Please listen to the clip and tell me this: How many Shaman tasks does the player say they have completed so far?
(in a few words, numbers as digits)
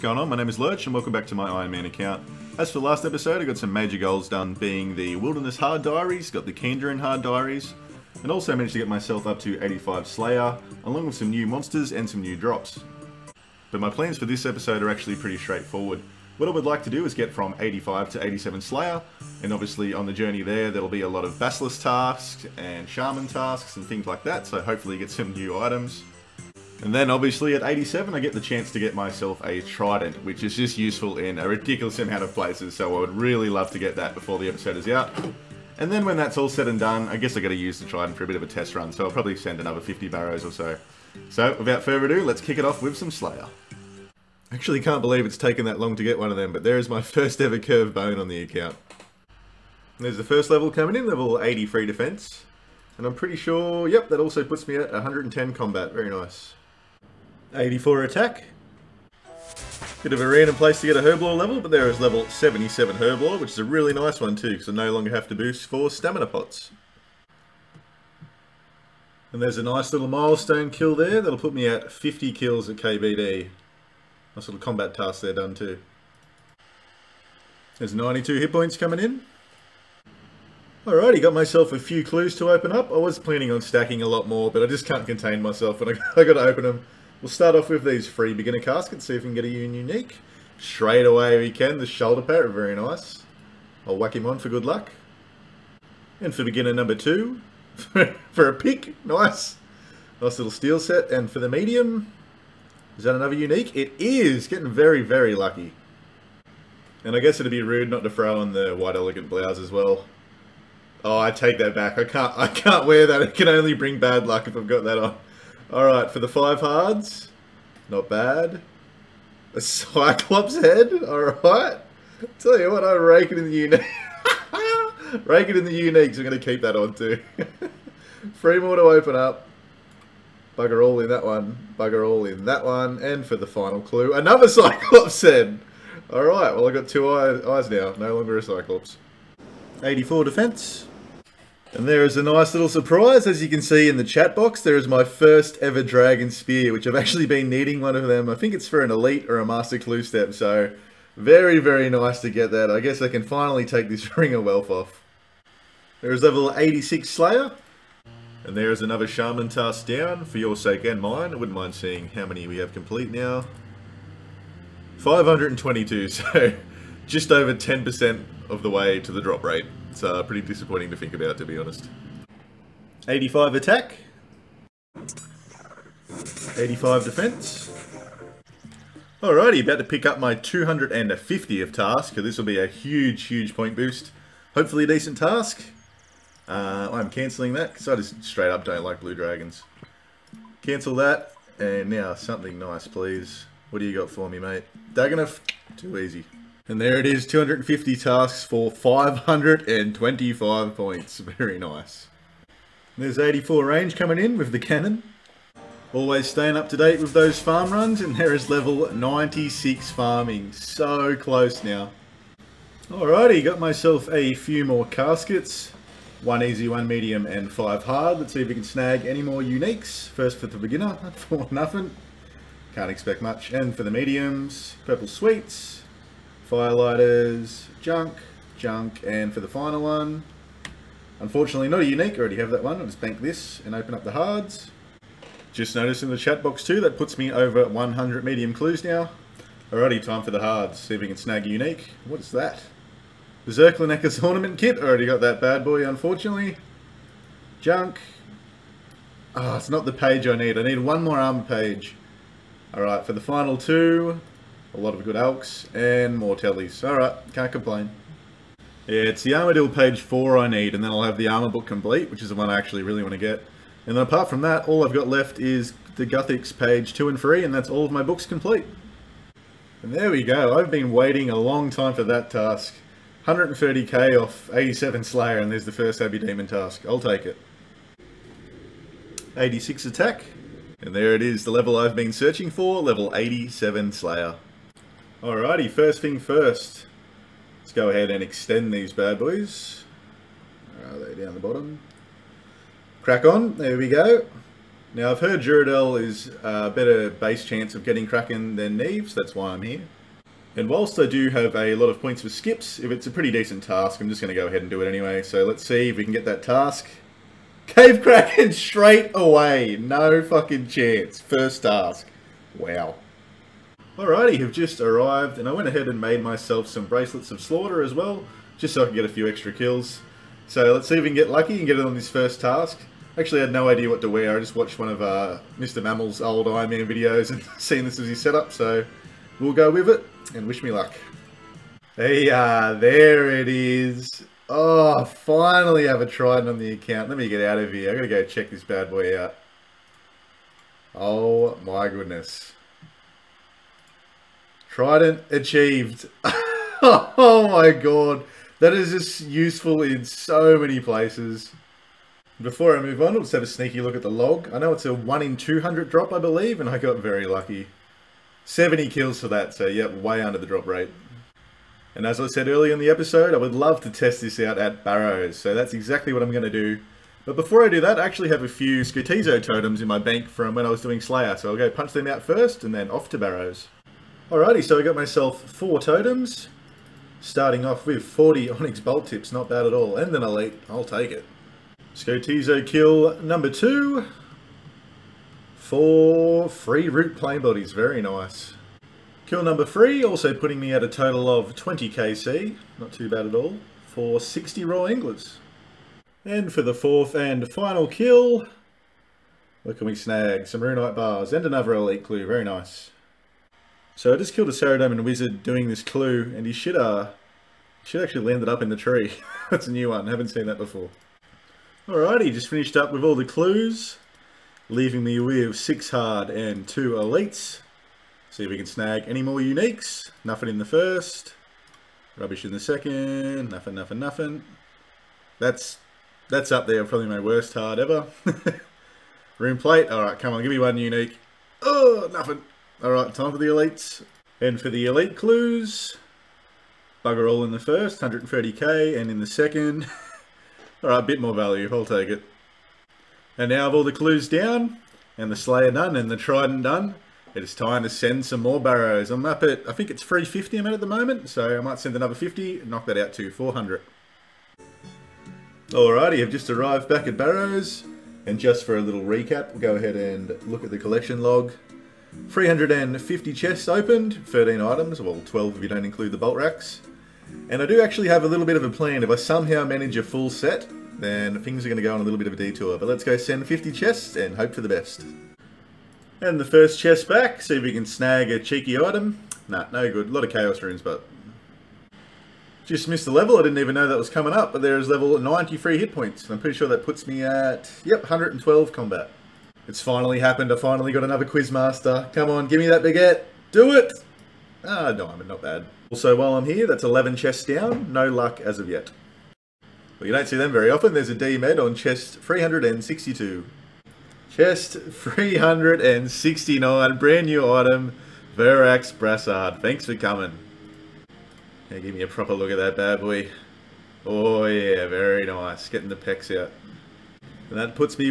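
522.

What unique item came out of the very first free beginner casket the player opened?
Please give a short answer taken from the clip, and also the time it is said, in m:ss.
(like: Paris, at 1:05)
Shoulder parrot, at 1:31.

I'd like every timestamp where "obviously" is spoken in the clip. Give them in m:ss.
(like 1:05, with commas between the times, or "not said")
0:19, 0:27.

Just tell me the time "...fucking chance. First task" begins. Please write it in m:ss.
5:10.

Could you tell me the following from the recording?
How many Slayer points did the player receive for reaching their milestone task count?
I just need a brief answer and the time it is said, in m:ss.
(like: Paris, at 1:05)
525, at 3:18.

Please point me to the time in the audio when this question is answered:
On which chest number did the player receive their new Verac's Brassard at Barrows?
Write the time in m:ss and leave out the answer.
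8:24.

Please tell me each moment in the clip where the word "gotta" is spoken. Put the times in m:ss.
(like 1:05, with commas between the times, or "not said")
0:37, 1:26.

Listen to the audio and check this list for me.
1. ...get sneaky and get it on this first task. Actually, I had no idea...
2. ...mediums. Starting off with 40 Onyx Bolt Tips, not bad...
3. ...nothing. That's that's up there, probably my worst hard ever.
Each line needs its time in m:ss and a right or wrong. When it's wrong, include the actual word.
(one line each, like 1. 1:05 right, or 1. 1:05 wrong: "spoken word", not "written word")
1. 5:21 wrong: "lucky", not "sneaky"
2. 6:15 wrong: "totems", not "mediums"
3. 7:03 right.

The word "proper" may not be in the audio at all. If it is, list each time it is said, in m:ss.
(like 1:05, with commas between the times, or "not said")
8:32.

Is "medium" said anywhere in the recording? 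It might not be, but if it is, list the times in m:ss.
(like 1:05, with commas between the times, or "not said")
1:41, 3:36, 3:43, 3:58.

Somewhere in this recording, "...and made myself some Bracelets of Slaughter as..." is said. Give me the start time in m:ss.
5:15.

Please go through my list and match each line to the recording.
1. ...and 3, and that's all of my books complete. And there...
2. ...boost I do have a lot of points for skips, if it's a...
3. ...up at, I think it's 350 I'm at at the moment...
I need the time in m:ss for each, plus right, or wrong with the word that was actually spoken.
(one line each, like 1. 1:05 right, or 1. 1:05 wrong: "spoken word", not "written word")
1. 4:27 right
2. 5:00 wrong: "whilst", not "boost"
3. 7:29 right.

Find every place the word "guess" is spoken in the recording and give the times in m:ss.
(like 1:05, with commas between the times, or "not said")
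0:37, 1:47, 2:32.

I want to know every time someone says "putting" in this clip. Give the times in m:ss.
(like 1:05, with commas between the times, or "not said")
6:30.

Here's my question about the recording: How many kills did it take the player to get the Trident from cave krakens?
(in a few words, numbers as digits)
70.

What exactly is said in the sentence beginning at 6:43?
So I just killed a Saradomin Wizard doing this clue, and he should, uh, should actually landed up in the tree.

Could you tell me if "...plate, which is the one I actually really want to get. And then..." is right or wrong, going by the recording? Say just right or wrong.
wrong.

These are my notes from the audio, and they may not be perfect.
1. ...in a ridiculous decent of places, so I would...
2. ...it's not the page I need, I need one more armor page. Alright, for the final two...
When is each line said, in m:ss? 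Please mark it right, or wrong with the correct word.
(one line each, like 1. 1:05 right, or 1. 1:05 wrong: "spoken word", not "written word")
1. 0:31 wrong: "amount", not "decent"
2. 4:09 right.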